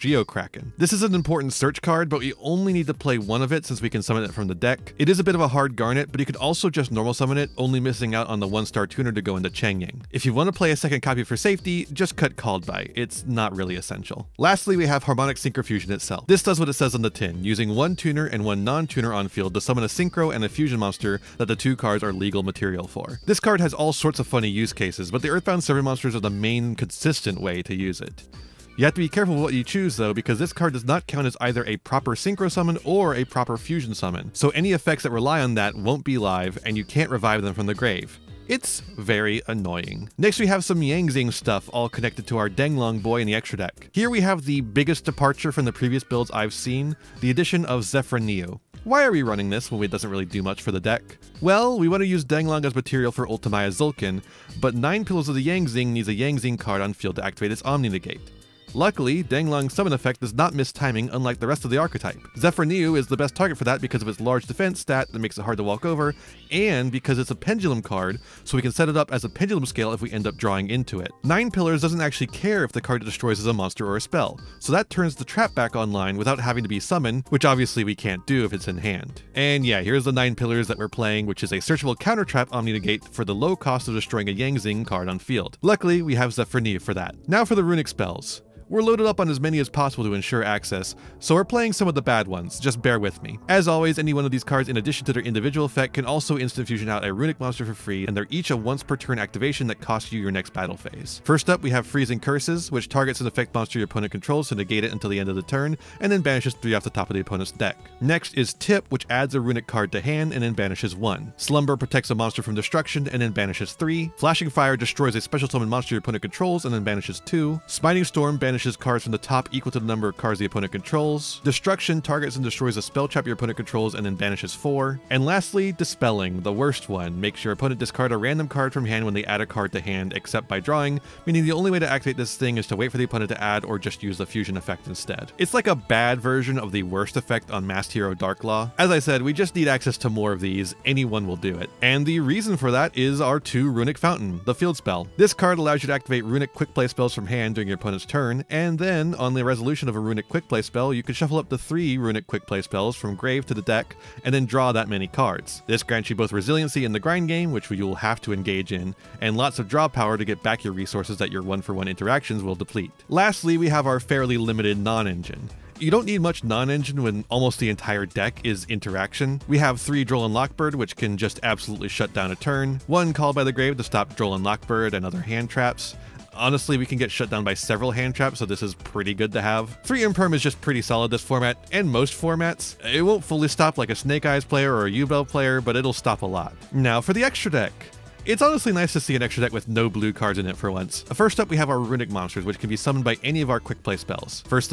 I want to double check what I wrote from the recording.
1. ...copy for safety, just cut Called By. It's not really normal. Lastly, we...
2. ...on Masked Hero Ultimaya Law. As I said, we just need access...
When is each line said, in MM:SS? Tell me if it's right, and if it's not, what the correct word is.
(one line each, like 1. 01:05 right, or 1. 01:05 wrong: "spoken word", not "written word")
1. 00:11 wrong: "essential", not "normal"
2. 02:17 wrong: "Dark", not "Ultimaya".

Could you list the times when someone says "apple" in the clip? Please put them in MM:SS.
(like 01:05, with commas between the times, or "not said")
not said.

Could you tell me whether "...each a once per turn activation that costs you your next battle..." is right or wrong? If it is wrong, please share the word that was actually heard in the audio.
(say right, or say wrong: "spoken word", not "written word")
right.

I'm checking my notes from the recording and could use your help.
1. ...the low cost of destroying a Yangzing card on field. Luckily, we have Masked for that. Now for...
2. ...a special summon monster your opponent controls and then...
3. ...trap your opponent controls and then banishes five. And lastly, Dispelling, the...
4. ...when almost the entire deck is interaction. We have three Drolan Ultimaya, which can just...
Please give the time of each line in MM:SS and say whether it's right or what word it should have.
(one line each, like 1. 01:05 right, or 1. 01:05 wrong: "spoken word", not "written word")
1. 01:23 wrong: "Zefraniu", not "Masked"
2. 01:55 right
3. 02:03 wrong: "four", not "five"
4. 02:47 wrong: "Lockbird", not "Ultimaya".